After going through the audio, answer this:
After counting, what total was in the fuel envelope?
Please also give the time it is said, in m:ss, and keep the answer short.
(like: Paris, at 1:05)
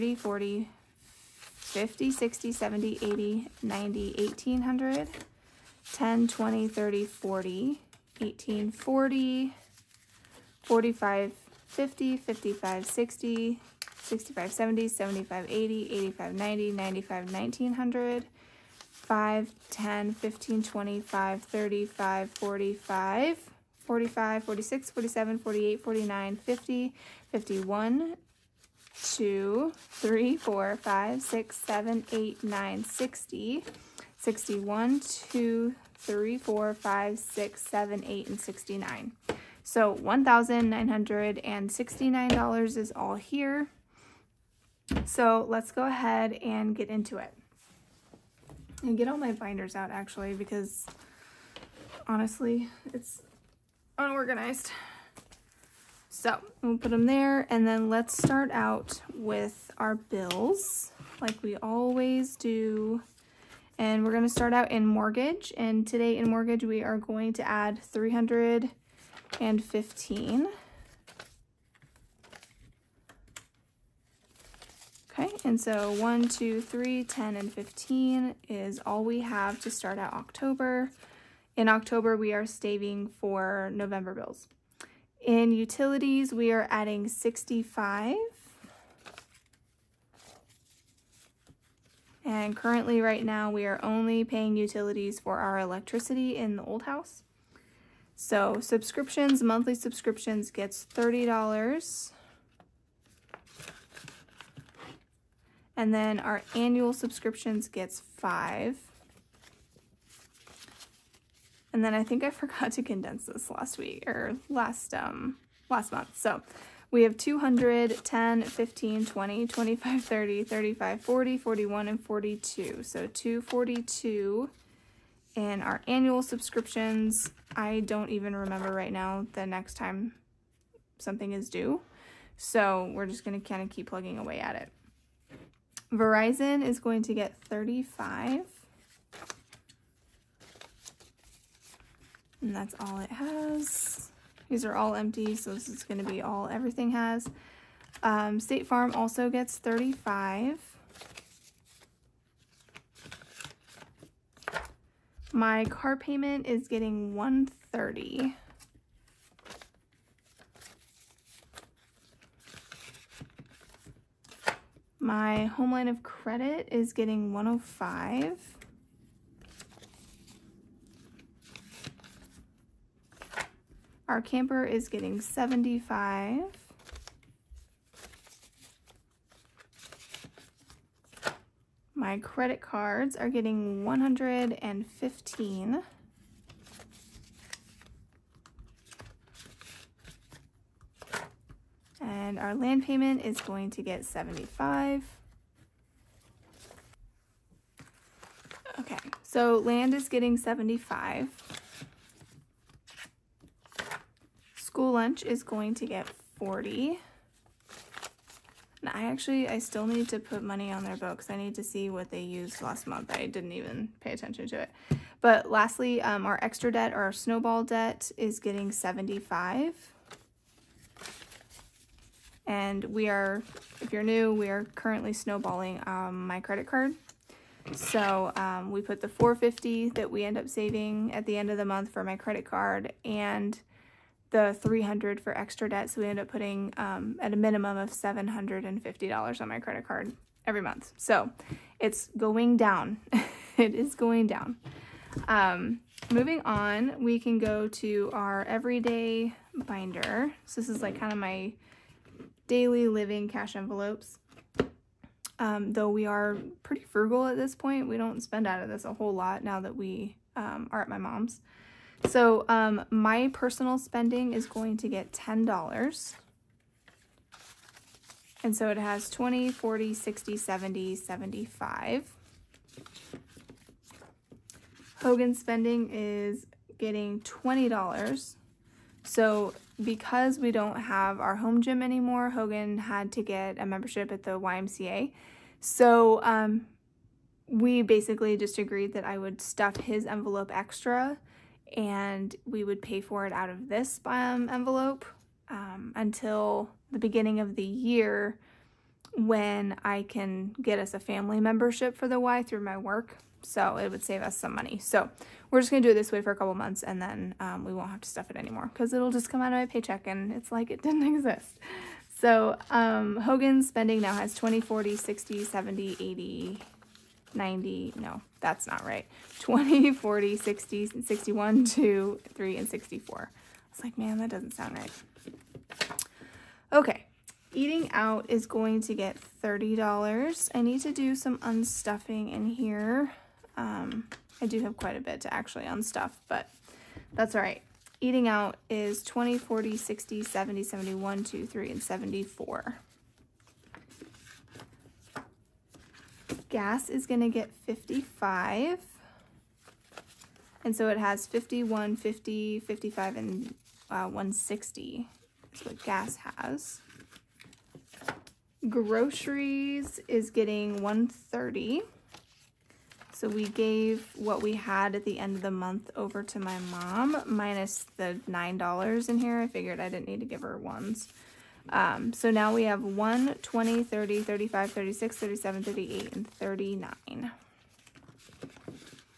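$160, at 5:54.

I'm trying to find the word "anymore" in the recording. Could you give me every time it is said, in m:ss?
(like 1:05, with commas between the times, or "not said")
4:41, 5:08.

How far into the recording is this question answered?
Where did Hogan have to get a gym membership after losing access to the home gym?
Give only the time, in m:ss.
4:44.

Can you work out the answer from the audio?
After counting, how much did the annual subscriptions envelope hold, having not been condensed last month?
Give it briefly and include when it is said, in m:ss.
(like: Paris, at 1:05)
$242, at 2:02.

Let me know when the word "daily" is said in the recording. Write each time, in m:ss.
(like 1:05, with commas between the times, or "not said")
4:12.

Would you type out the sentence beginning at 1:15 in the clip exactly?
Okay, and so 1, 2, 3, 10, and 15 is all we have to start at October.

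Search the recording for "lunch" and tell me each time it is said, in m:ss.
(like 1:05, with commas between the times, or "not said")
3:24.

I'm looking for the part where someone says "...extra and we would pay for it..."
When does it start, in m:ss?
4:50.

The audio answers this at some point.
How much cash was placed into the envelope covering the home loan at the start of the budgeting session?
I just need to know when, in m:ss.
1:07.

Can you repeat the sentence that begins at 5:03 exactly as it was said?
So it would save us some money.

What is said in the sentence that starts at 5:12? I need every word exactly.
So um, Hogan's spending now has 20, 40, 60, 70, 80, 90, no, that's not right.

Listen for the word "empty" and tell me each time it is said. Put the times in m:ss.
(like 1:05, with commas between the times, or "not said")
2:24.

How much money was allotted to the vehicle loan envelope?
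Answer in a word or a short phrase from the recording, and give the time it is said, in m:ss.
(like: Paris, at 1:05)
$130, at 2:35.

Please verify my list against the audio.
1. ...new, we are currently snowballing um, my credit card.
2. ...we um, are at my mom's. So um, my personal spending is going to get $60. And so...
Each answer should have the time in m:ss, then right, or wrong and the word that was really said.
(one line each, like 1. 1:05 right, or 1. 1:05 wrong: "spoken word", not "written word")
1. 3:44 right
2. 4:19 wrong: "10", not "60".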